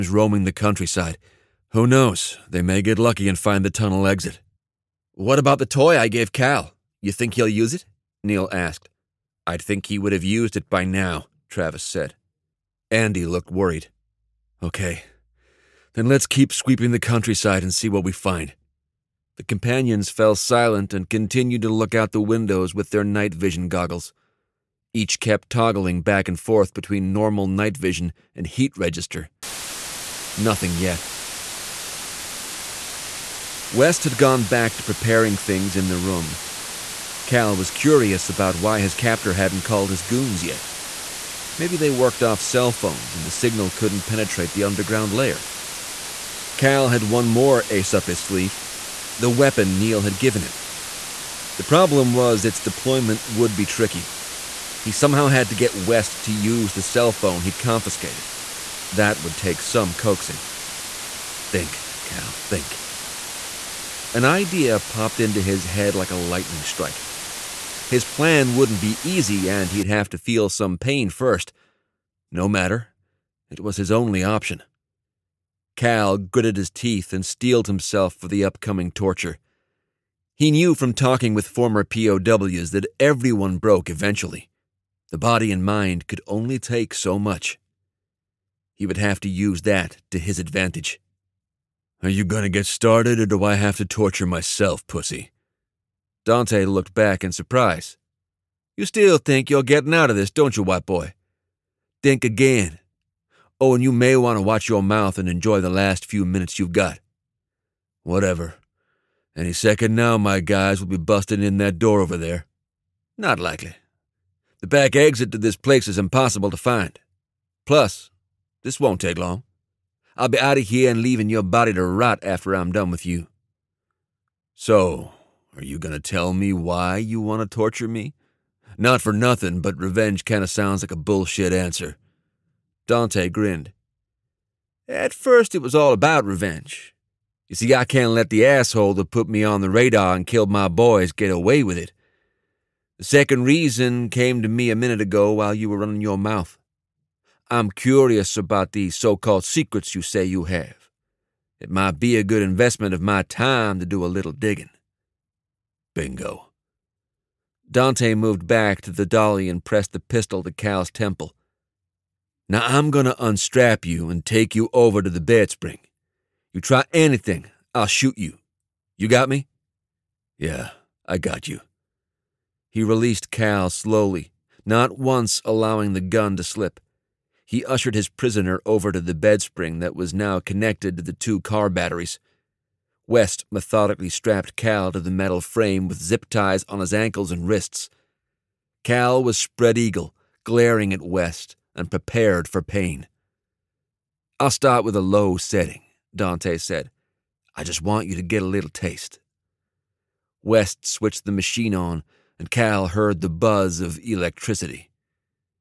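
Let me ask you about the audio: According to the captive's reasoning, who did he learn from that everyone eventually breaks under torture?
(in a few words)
former POWs.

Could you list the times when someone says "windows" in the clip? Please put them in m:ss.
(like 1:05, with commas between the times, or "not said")
0:22.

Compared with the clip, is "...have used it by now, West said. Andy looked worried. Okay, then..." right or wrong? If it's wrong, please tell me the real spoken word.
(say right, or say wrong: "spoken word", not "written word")
wrong: "Travis", not "West".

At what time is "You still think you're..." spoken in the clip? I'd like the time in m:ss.
1:38.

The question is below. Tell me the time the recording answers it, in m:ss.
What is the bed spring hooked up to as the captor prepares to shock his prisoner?
3:01.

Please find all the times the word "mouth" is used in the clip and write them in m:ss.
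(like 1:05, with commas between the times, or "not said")
1:44, 2:26.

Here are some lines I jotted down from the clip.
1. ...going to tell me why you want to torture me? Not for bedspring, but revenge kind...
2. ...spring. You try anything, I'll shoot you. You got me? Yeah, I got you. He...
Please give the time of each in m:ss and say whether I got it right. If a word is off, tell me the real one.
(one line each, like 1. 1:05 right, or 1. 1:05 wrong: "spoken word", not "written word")
1. 2:05 wrong: "nothing", not "bedspring"
2. 2:45 right.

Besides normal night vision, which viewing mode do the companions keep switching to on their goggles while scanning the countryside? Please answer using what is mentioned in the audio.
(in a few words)
heat register.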